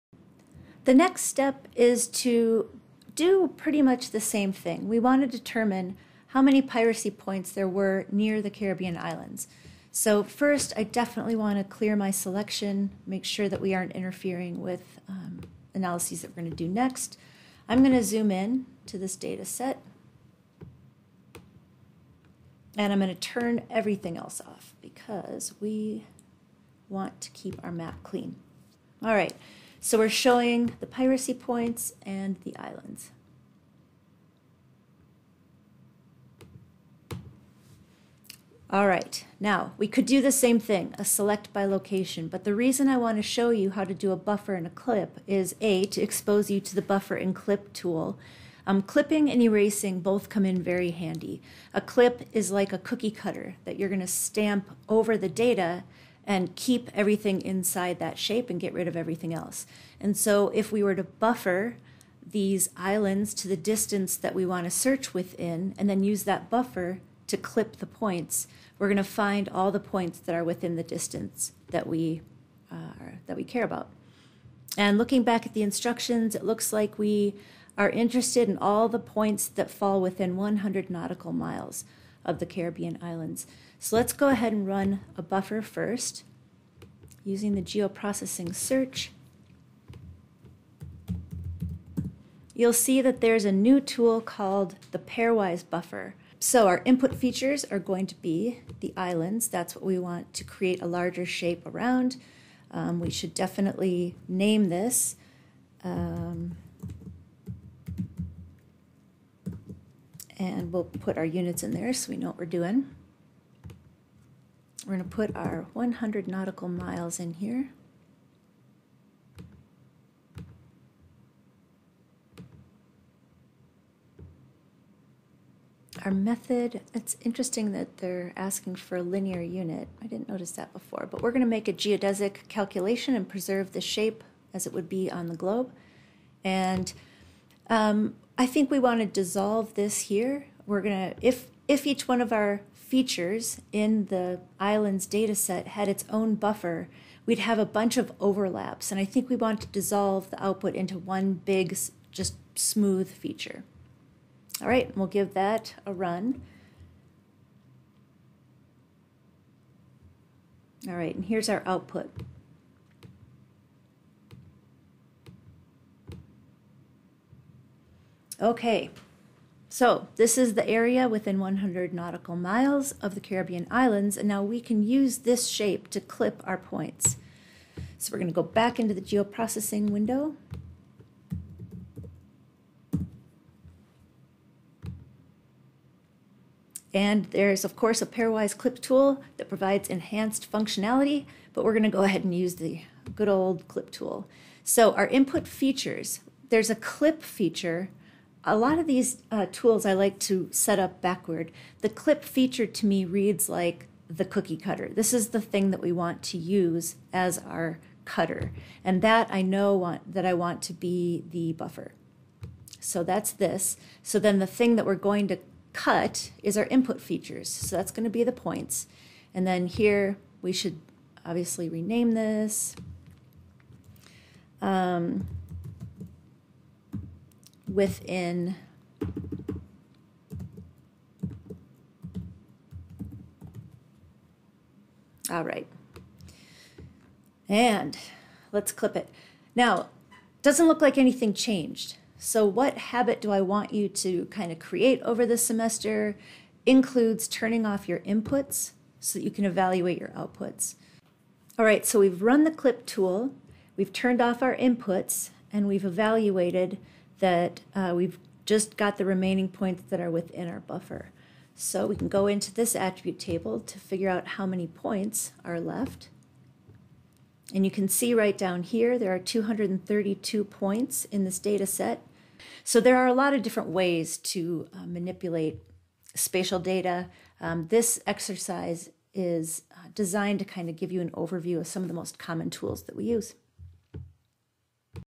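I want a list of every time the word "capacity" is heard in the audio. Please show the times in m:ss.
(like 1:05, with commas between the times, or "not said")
not said.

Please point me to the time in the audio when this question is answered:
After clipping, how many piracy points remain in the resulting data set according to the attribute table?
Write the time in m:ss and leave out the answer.
4:29.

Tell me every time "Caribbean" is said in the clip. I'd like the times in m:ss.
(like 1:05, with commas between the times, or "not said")
0:08, 1:22, 2:53.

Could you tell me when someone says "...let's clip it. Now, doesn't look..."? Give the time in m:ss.
3:58.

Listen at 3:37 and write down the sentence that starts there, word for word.
So that's going to be the points.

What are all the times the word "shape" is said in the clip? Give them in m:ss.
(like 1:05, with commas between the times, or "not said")
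0:58, 1:41, 2:13, 2:55.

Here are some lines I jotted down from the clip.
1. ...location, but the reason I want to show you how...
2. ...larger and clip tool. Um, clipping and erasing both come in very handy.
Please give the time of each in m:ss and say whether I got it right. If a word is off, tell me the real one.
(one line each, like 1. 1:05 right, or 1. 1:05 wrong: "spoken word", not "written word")
1. 0:41 right
2. 0:46 wrong: "buffer", not "larger".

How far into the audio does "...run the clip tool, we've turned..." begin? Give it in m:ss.
4:12.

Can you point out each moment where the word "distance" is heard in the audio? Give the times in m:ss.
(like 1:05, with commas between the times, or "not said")
1:03, 1:10.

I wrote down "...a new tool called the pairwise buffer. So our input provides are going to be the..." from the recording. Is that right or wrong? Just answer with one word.
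wrong.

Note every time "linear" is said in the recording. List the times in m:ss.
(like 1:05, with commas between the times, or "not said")
2:09.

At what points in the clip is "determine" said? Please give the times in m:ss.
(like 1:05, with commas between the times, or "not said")
0:05.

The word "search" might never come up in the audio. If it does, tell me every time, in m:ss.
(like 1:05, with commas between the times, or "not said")
1:04, 1:28.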